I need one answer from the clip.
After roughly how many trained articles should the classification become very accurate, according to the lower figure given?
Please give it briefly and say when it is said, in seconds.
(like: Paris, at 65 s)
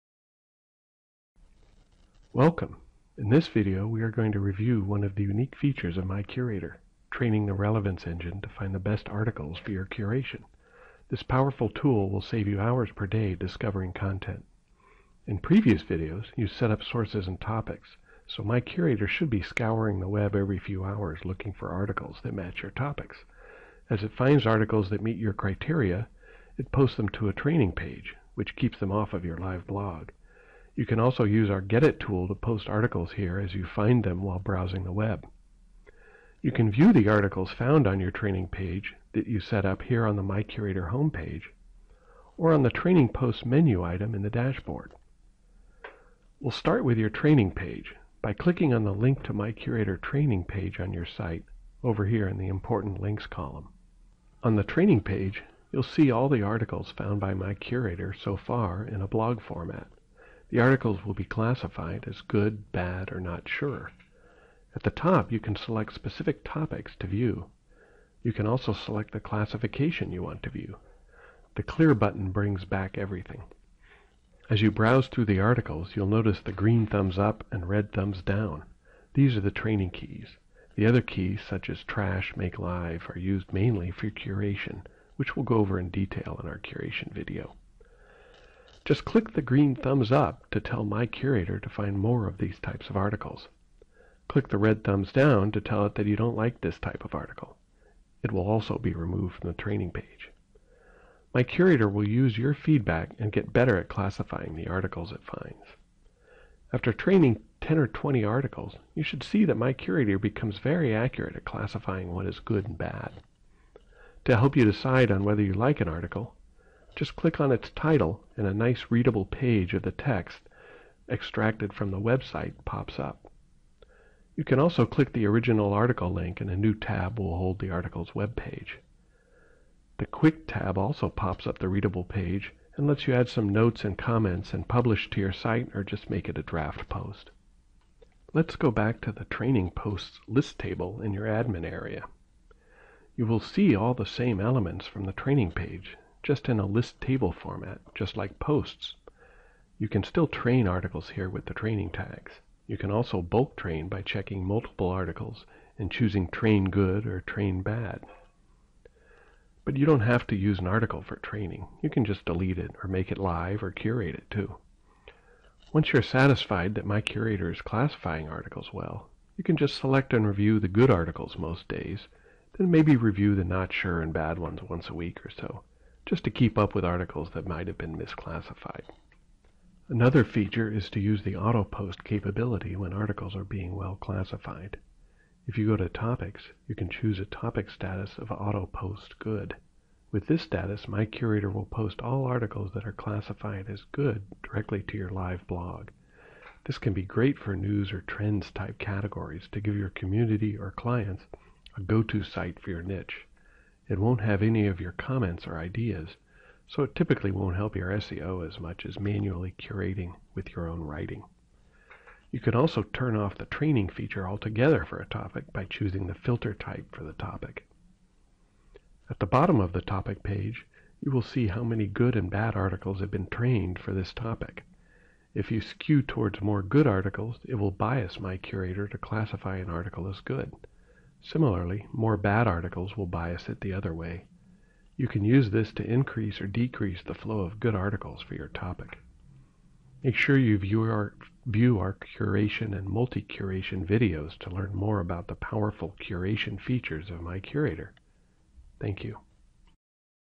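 10, at 107 s.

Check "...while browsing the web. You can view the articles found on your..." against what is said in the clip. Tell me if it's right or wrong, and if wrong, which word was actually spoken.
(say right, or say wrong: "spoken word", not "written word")
right.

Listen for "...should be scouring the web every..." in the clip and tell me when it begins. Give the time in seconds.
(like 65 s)
19 s.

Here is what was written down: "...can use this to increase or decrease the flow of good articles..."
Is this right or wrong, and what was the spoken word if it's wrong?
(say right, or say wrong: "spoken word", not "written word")
right.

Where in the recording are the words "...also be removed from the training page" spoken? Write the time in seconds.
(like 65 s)
98 s.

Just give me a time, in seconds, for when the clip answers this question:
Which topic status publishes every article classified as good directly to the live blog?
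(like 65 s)
188 s.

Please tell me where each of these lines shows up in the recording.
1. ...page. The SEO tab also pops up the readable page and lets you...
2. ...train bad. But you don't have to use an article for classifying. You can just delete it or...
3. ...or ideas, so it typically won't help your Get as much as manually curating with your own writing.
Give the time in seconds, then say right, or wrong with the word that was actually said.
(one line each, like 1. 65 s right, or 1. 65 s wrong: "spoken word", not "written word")
1. 128 s wrong: "Quick", not "SEO"
2. 157 s wrong: "training", not "classifying"
3. 205 s wrong: "SEO", not "Get".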